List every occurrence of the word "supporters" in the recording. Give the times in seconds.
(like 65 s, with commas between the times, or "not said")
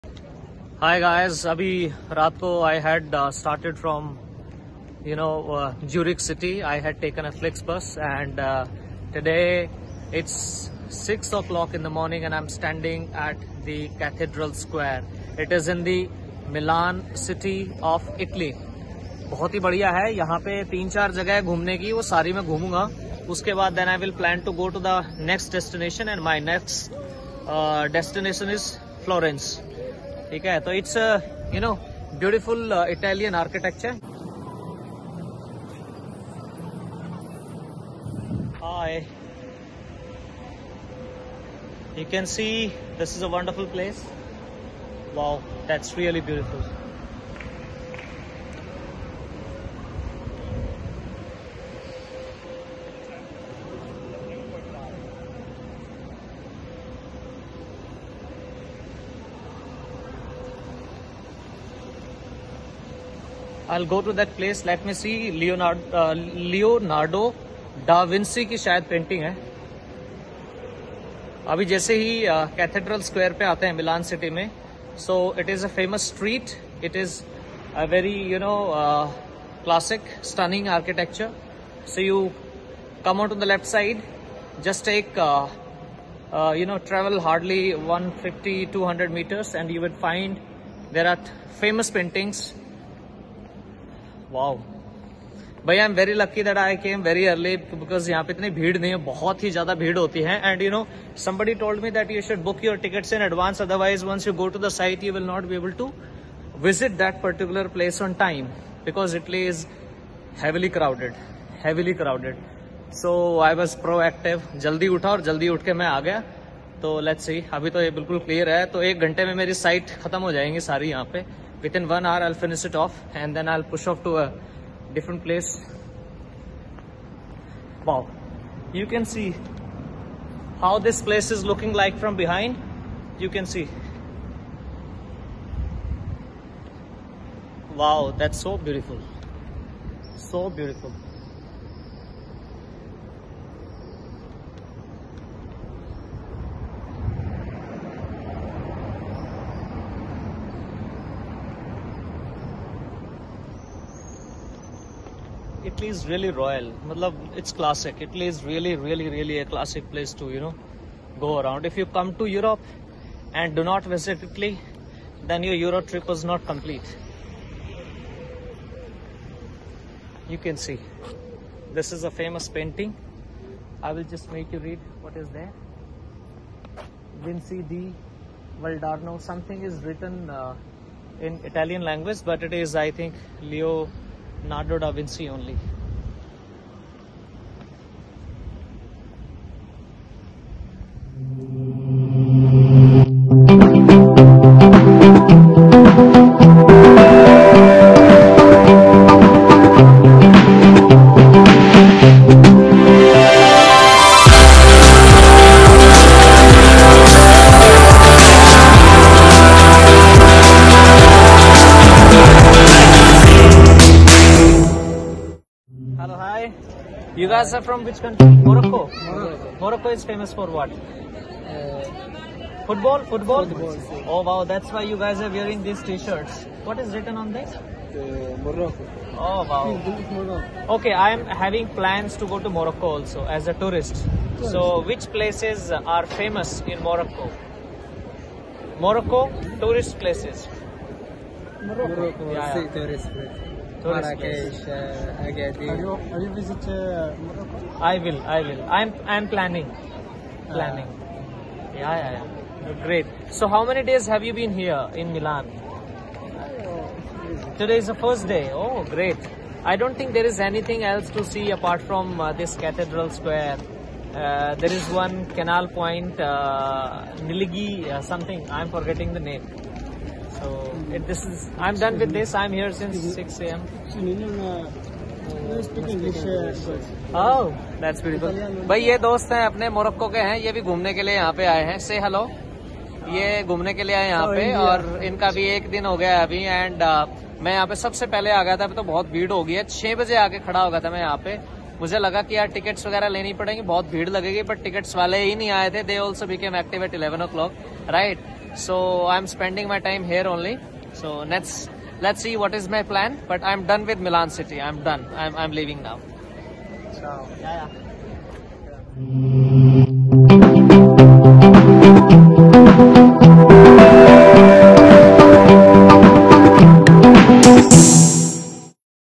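not said.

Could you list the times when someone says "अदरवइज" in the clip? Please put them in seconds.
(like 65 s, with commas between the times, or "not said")
103 s.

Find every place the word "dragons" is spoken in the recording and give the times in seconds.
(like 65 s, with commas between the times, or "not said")
not said.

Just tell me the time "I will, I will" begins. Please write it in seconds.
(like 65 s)
247 s.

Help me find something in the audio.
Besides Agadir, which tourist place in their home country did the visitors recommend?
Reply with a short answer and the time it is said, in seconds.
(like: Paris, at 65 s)
Marrakesh, at 243 s.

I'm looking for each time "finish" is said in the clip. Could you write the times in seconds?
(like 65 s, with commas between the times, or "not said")
122 s.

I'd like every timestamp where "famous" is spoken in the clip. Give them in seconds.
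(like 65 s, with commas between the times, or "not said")
172 s, 220 s, 236 s.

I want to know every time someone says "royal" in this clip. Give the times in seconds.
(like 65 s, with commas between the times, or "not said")
156 s.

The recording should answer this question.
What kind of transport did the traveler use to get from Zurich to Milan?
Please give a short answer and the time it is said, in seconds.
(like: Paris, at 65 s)
Flex bus, at 7 s.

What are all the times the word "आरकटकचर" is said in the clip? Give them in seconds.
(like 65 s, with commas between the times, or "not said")
33 s, 80 s.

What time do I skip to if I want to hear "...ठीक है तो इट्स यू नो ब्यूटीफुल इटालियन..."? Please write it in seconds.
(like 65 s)
30 s.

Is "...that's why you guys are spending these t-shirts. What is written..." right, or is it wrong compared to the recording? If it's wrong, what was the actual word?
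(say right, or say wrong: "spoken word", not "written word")
wrong: "wearing", not "spending".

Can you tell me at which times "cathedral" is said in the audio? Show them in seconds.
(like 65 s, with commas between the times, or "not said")
13 s, 262 s.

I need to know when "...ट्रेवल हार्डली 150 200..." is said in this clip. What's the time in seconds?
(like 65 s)
86 s.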